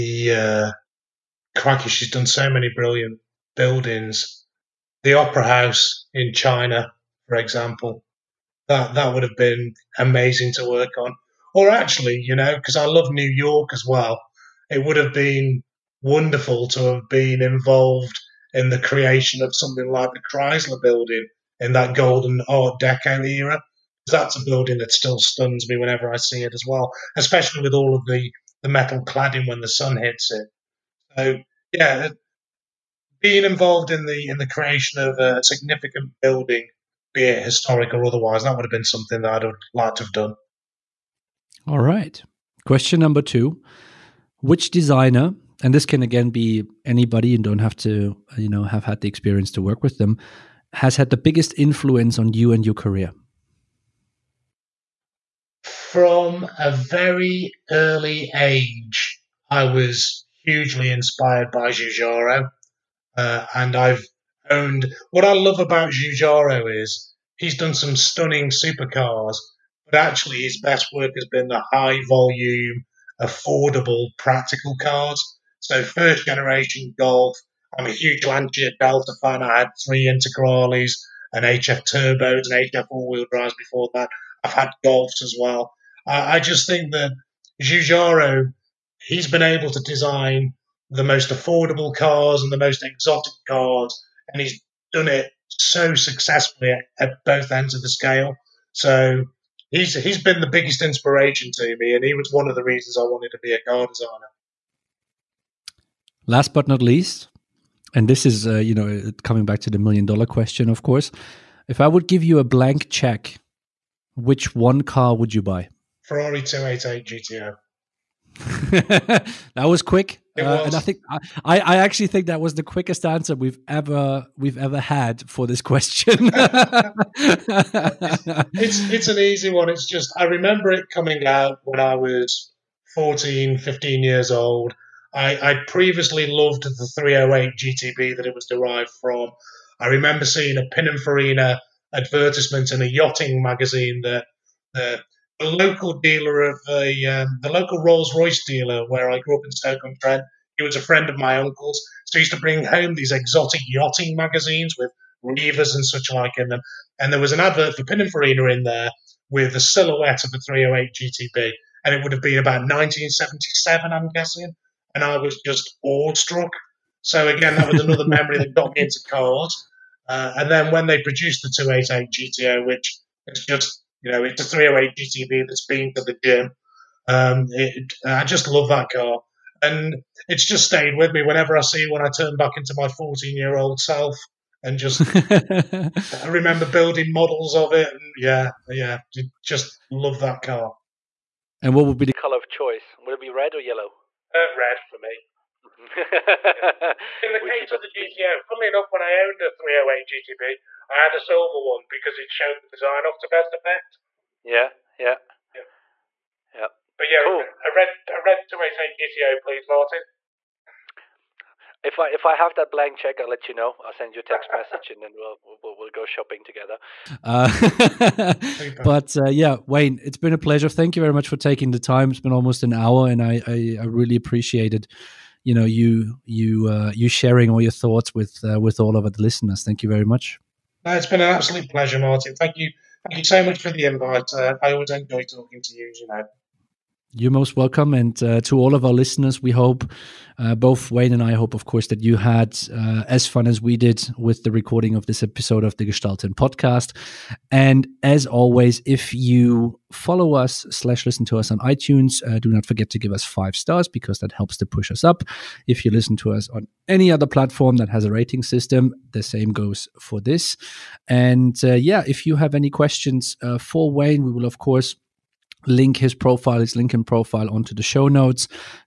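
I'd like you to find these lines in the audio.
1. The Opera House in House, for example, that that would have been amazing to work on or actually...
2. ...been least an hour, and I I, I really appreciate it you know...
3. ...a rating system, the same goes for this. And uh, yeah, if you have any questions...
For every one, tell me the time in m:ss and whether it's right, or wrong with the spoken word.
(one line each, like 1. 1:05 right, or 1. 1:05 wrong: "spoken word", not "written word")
1. 0:05 wrong: "China", not "House"
2. 3:42 wrong: "almost", not "least"
3. 4:18 right.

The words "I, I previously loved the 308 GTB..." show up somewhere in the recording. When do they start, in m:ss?
2:15.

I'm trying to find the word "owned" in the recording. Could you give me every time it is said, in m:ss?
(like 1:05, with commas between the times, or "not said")
1:04, 3:19.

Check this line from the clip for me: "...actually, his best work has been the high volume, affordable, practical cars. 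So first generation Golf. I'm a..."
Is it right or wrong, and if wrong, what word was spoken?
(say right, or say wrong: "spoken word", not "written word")
right.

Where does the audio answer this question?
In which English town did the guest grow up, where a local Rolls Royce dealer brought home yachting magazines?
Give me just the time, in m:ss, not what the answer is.
2:29.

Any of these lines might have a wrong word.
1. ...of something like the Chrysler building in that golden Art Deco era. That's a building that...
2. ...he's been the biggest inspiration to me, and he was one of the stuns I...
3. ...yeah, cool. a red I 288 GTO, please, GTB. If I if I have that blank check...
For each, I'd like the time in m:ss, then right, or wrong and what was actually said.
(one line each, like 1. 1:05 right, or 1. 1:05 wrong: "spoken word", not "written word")
1. 0:19 right
2. 1:40 wrong: "reasons", not "stuns"
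3. 3:27 wrong: "Martin", not "GTB".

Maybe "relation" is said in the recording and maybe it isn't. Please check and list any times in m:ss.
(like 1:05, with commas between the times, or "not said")
not said.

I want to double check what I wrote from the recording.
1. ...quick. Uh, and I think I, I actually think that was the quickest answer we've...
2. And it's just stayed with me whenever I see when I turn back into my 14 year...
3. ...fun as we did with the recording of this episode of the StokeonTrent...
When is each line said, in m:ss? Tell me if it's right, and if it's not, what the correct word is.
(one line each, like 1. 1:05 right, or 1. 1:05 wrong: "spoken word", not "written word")
1. 1:59 right
2. 2:59 right
3. 4:03 wrong: "Gestalten", not "StokeonTrent".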